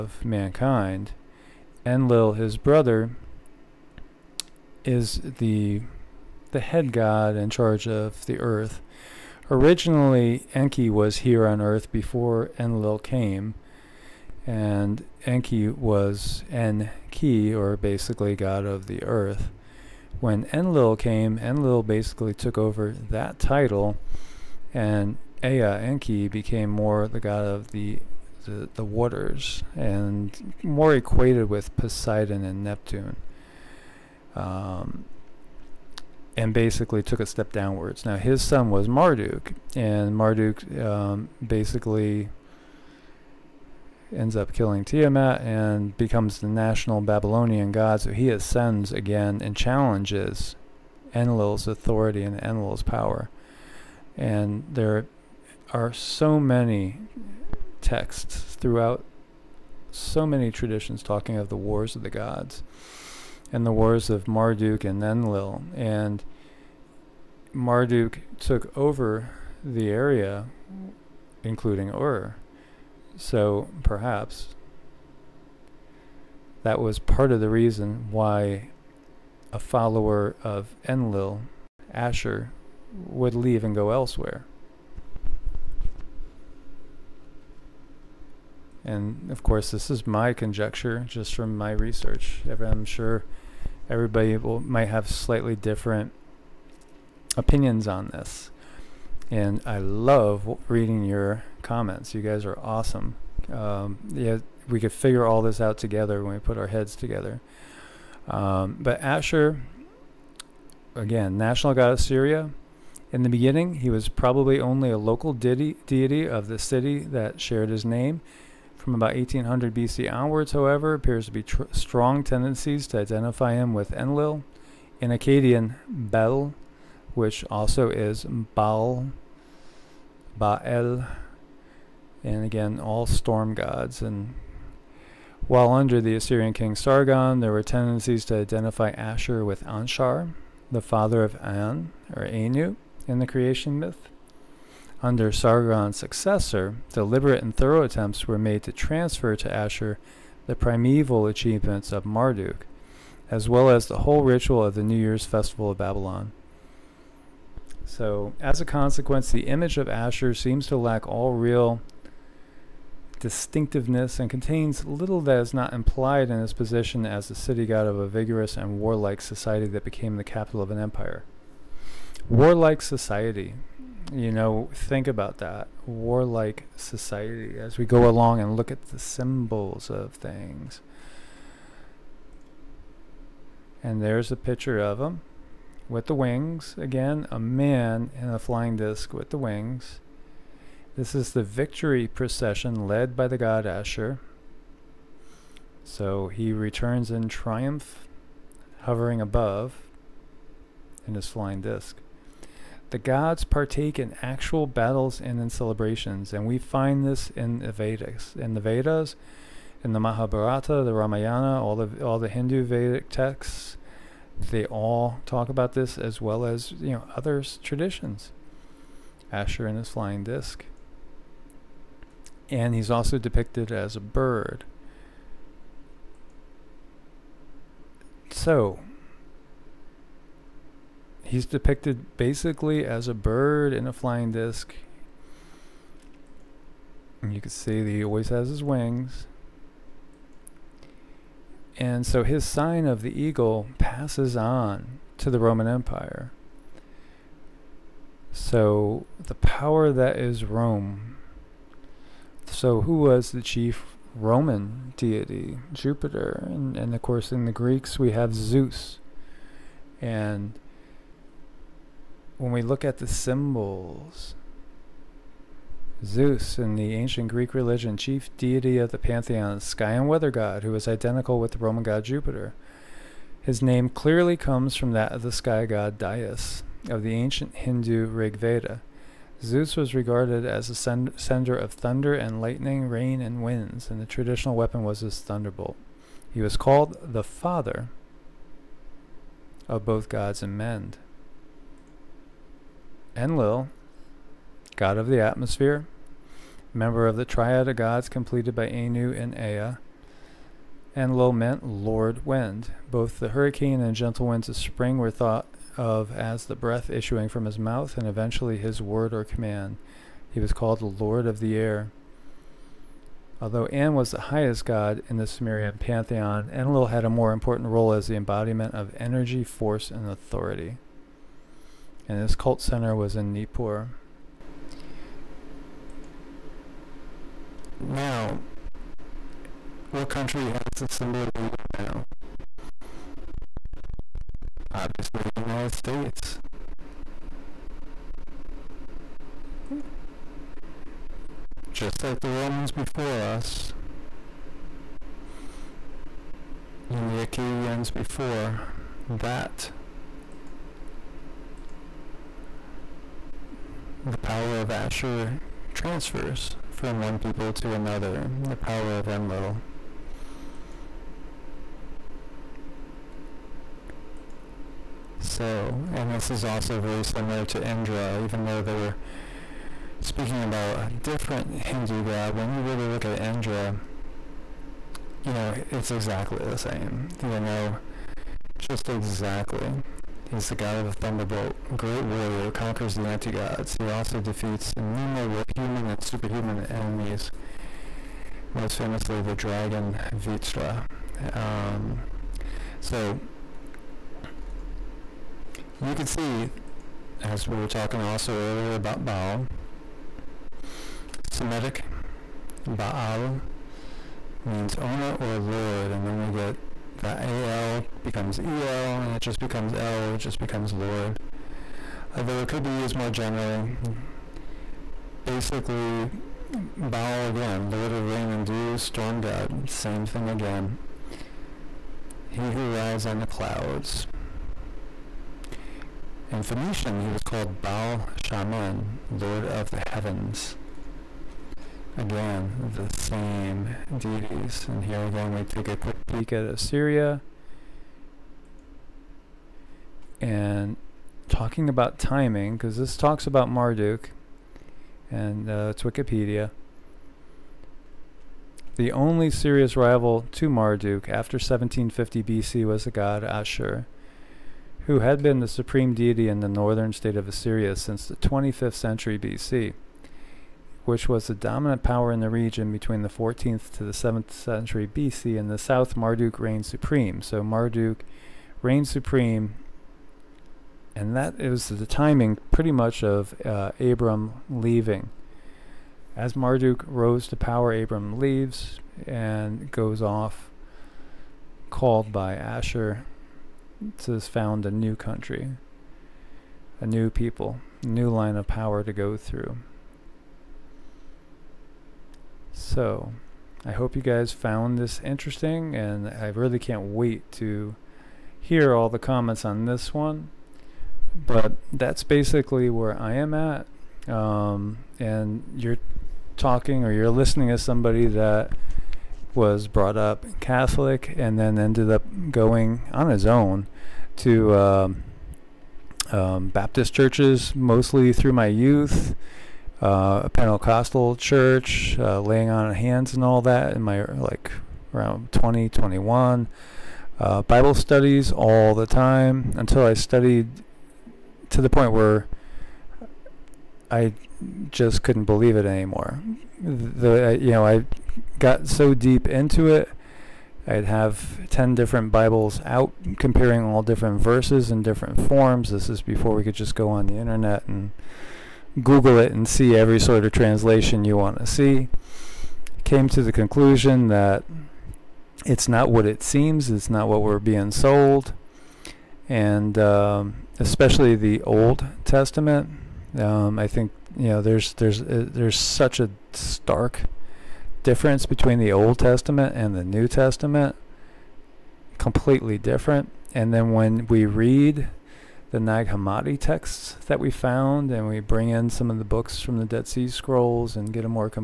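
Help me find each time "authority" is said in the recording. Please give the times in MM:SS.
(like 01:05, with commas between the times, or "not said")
00:51, 05:20.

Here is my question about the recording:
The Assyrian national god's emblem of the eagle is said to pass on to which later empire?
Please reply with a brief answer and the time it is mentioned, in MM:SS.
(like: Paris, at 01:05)
Roman Empire, at 04:05.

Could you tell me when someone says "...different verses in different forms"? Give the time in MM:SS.
09:03.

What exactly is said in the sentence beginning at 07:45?
and the south, Marduk reigned supreme.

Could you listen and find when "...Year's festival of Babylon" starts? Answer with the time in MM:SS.
02:34.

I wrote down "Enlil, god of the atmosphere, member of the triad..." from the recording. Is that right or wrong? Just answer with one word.
right.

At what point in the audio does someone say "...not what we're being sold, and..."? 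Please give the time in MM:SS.
09:16.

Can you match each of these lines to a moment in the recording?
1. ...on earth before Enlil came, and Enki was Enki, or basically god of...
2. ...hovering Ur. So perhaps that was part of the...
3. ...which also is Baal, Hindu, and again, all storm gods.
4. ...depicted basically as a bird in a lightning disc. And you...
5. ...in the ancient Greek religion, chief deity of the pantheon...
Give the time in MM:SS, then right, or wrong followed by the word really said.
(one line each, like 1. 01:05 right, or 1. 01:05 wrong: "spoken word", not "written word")
1. 00:11 right
2. 01:11 wrong: "including", not "hovering"
3. 02:07 wrong: "Baal", not "Hindu"
4. 03:51 wrong: "flying", not "lightning"
5. 04:26 right.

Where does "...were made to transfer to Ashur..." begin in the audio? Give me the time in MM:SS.
02:28.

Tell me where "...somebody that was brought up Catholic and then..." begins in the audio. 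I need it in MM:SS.
08:27.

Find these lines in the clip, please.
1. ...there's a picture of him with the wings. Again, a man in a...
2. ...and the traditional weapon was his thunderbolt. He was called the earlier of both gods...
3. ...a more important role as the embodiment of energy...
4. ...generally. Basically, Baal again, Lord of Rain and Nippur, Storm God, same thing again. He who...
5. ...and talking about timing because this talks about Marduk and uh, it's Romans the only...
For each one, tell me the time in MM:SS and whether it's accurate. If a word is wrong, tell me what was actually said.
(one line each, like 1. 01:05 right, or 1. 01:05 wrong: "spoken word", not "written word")
1. 03:04 right
2. 04:43 wrong: "father", not "earlier"
3. 05:17 right
4. 06:53 wrong: "Dew", not "Nippur"
5. 07:20 wrong: "Wikipedia", not "Romans".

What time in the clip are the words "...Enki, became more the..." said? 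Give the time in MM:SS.
00:25.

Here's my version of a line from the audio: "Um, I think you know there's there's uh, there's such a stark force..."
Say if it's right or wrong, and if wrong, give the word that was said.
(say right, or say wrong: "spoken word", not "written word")
wrong: "difference", not "force".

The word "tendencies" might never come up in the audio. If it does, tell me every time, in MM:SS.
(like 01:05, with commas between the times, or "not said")
02:02, 02:17.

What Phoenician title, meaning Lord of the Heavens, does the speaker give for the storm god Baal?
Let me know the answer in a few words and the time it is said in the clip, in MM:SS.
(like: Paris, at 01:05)
Baal Shaman, at 07:07.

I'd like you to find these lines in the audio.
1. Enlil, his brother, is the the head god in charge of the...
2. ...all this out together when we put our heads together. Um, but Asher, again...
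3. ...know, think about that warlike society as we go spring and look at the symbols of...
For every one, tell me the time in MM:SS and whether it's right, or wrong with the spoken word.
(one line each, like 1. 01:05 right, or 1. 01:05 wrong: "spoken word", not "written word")
1. 00:01 right
2. 01:45 right
3. 02:54 wrong: "along", not "spring".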